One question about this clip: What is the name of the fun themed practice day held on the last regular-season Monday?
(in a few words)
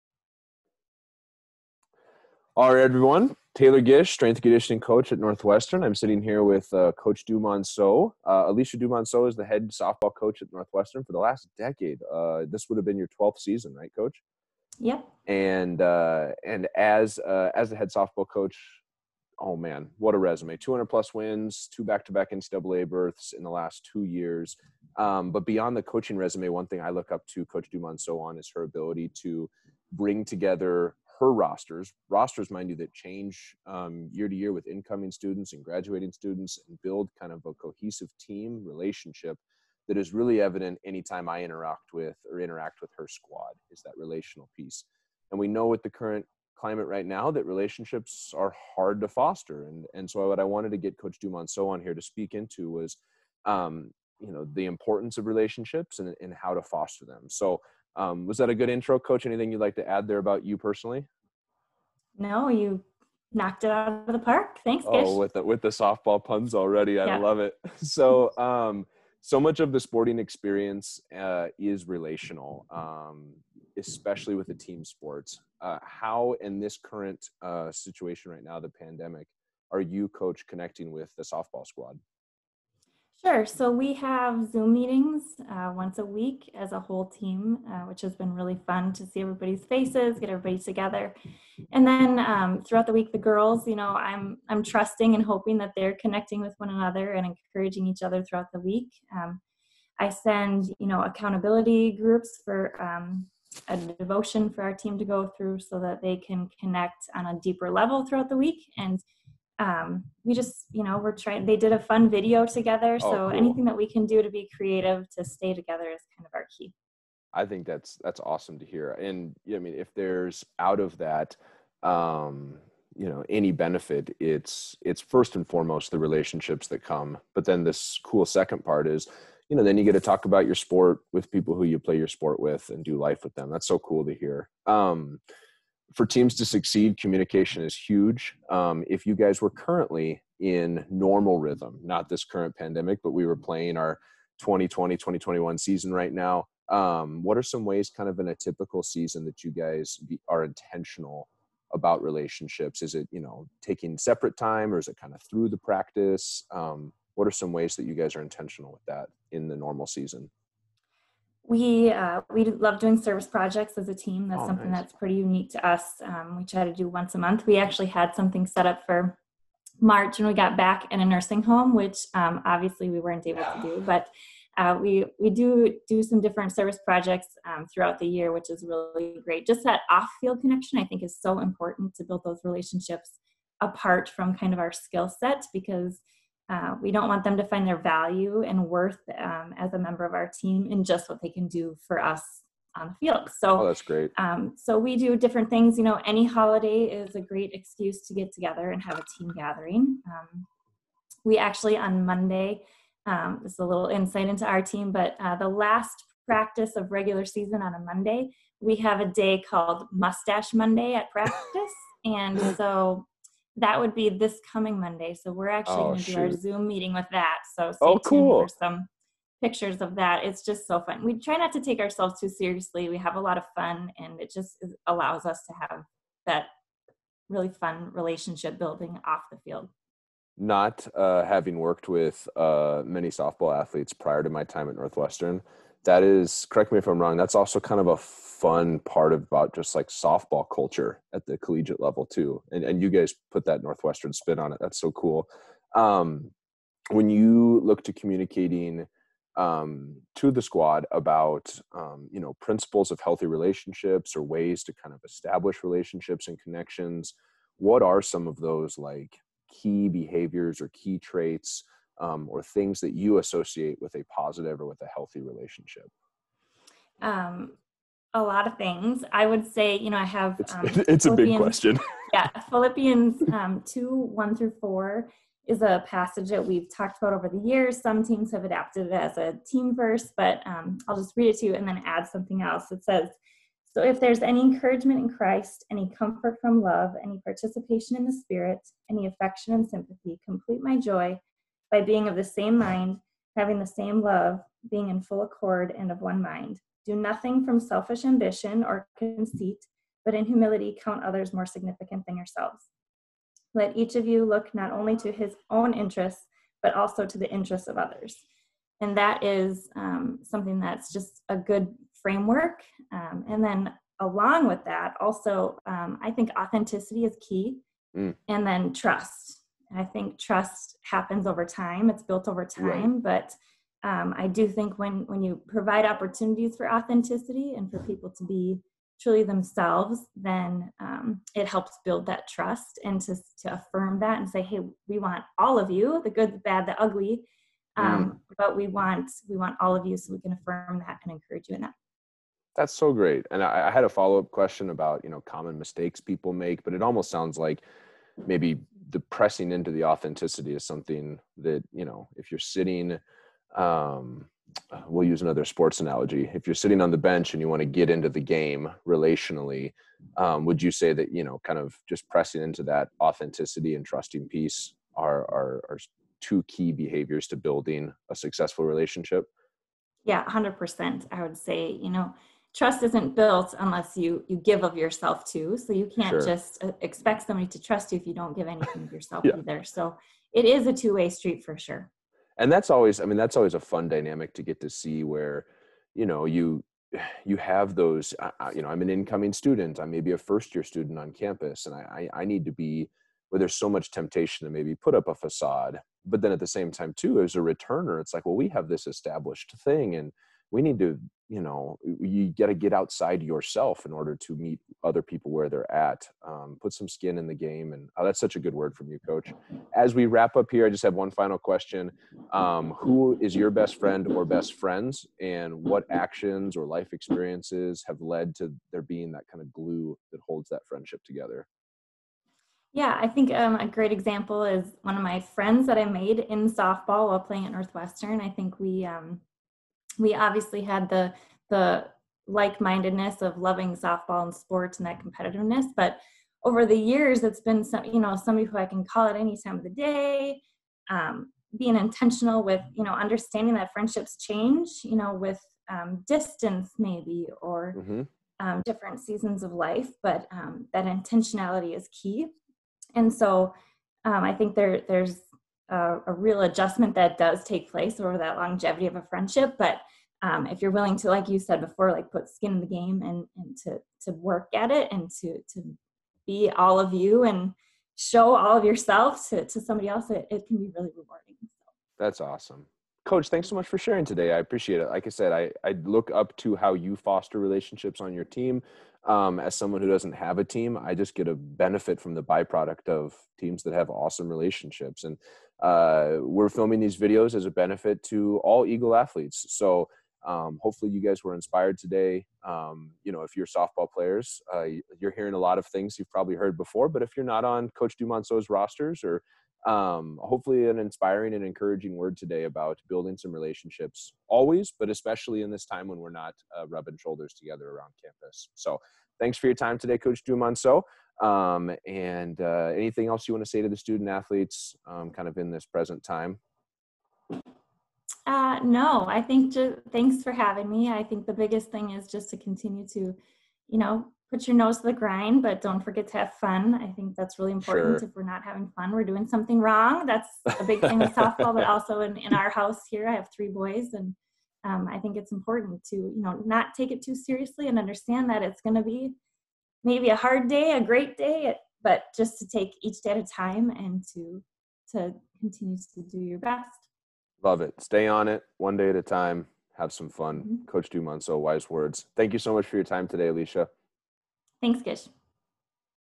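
Mustache Monday.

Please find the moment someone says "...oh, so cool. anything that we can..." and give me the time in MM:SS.
01:53.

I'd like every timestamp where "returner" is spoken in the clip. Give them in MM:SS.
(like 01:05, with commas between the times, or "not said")
06:37.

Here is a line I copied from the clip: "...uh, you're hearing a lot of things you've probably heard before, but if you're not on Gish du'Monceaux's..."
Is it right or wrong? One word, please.
wrong.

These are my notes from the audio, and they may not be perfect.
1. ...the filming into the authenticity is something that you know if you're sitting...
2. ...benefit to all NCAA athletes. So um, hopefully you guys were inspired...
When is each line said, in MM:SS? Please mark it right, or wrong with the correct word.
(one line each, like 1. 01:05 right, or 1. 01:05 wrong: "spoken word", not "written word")
1. 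05:48 wrong: "pressing", not "filming"
2. 08:07 wrong: "Eagle", not "NCAA".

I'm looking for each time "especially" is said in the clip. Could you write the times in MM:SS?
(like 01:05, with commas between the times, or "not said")
01:13, 08:24.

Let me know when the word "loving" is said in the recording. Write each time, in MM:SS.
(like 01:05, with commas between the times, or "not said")
07:13.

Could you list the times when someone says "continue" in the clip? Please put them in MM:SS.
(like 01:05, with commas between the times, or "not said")
08:42, 09:05.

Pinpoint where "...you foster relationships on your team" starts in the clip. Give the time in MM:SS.
07:56.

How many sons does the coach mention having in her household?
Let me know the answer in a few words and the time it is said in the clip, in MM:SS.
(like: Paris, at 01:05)
3, at 08:53.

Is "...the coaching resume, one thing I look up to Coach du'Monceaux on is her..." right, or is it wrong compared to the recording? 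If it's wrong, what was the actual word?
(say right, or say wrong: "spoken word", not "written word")
right.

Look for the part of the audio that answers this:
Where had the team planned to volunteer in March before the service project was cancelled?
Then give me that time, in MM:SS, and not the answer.
02:51.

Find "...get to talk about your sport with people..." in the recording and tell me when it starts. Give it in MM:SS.
02:09.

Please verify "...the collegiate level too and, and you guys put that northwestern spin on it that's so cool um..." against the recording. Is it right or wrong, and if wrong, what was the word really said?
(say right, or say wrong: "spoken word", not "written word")
right.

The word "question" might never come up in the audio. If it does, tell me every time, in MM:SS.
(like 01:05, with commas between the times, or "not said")
04:31, 05:44, 06:51.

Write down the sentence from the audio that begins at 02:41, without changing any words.
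We uh, we love doing service projects as a team.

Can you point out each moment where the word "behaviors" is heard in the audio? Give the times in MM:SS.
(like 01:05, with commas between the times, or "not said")
04:19, 06:06.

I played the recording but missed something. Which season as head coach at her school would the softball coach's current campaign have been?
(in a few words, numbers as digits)
12th.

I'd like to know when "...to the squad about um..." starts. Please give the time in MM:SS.
04:10.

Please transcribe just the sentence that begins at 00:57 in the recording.
So um, was that a good intro, Coach?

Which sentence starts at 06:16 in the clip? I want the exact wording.
just uh, expect somebody to trust you if you don't give anything of yourself yeah.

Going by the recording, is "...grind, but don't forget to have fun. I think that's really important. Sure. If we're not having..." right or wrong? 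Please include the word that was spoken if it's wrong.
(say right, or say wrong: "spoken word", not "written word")
right.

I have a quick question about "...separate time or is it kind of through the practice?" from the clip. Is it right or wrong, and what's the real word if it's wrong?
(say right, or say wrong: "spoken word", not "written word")
right.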